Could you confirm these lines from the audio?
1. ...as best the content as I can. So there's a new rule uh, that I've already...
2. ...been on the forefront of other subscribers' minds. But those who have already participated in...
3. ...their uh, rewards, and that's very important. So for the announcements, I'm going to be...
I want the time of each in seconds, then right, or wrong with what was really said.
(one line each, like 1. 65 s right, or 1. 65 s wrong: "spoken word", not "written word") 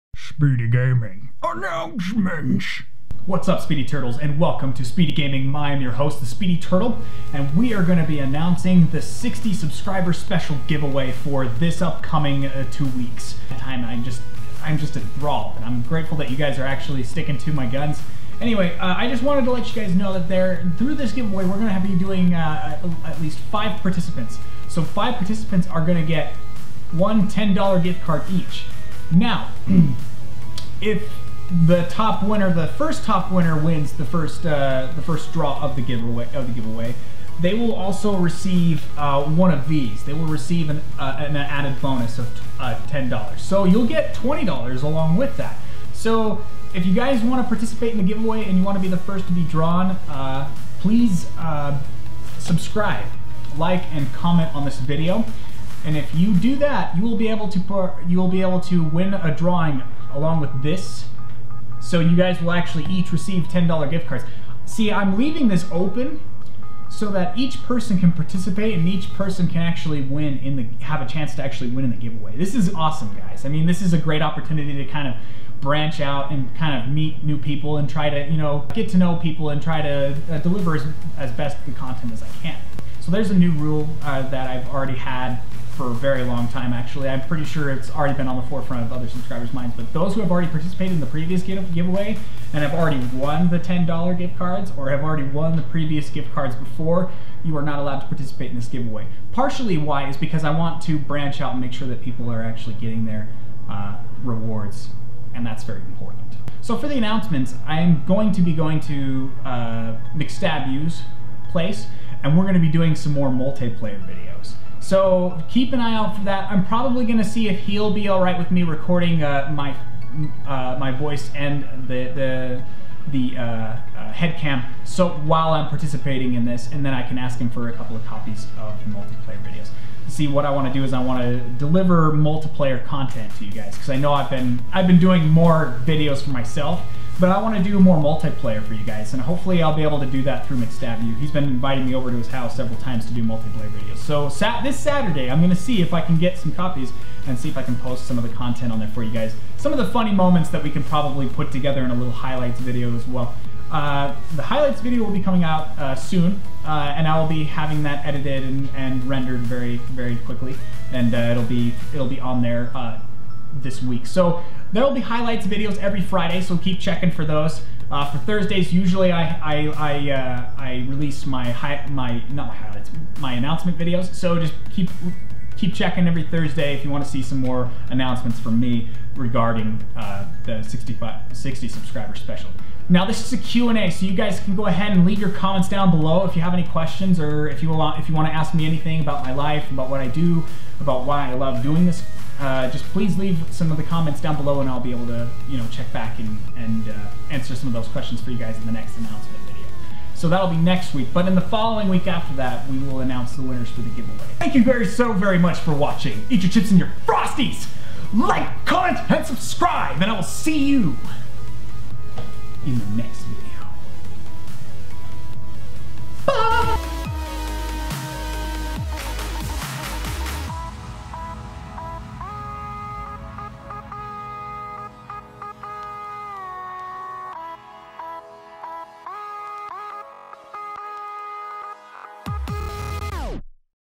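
1. 81 s right
2. 88 s right
3. 103 s right.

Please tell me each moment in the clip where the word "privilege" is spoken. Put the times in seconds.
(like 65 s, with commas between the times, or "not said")
not said.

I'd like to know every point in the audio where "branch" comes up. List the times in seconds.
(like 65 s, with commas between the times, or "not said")
75 s, 100 s.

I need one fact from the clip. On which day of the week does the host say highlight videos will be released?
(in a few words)
Friday.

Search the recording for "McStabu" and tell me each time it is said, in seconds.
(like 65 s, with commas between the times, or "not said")
110 s, 140 s.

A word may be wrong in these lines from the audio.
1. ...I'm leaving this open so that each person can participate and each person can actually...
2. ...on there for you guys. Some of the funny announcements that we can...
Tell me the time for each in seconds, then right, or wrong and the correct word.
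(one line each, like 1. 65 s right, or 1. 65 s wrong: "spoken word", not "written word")
1. 64 s right
2. 148 s wrong: "moments", not "announcements".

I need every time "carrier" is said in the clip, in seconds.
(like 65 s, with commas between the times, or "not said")
not said.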